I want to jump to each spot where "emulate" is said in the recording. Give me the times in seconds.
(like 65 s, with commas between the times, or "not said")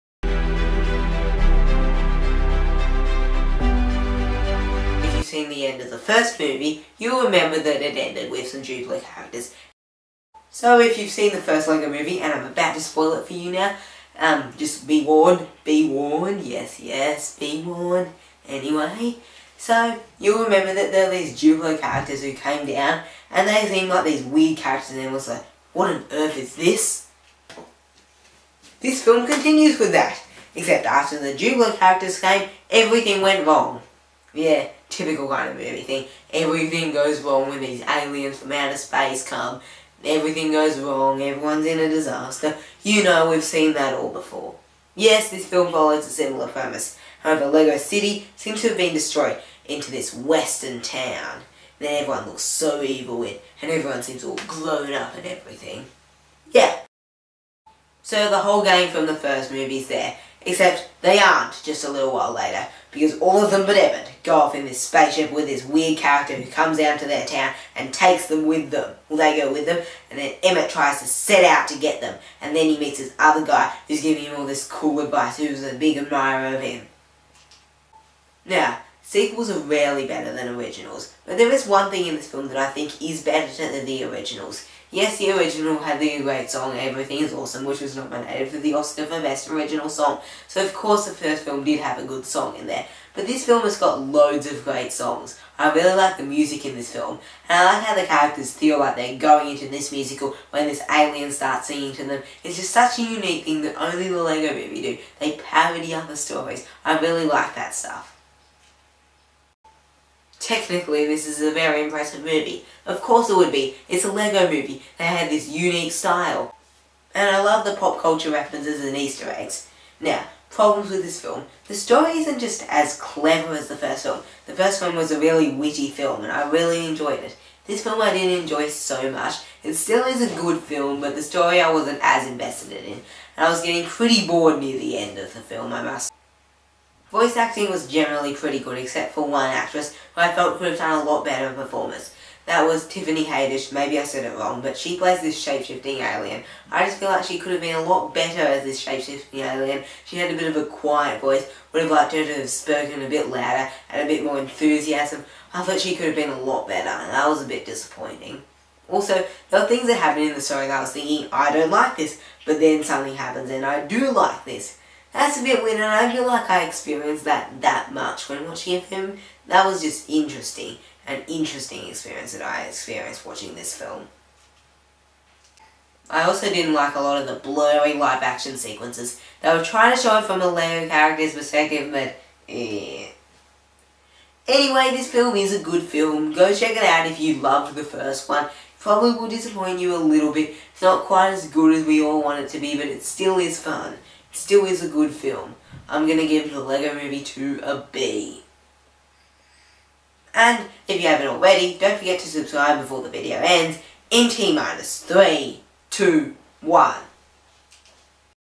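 not said.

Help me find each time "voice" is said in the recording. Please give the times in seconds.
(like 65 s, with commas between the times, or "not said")
137 s, 151 s.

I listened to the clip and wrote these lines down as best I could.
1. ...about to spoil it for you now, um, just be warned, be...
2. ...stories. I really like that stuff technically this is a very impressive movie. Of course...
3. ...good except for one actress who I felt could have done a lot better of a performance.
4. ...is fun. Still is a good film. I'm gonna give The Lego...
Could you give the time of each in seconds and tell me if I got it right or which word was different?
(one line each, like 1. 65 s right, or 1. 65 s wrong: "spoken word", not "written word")
1. 12 s right
2. 106 s right
3. 138 s right
4. 193 s right.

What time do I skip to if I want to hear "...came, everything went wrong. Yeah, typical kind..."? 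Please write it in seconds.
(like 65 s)
32 s.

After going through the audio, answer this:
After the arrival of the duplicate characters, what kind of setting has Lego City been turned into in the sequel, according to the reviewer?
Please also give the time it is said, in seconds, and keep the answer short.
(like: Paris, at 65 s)
Western town, at 50 s.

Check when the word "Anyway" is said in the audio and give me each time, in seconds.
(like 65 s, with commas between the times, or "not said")
18 s, 184 s.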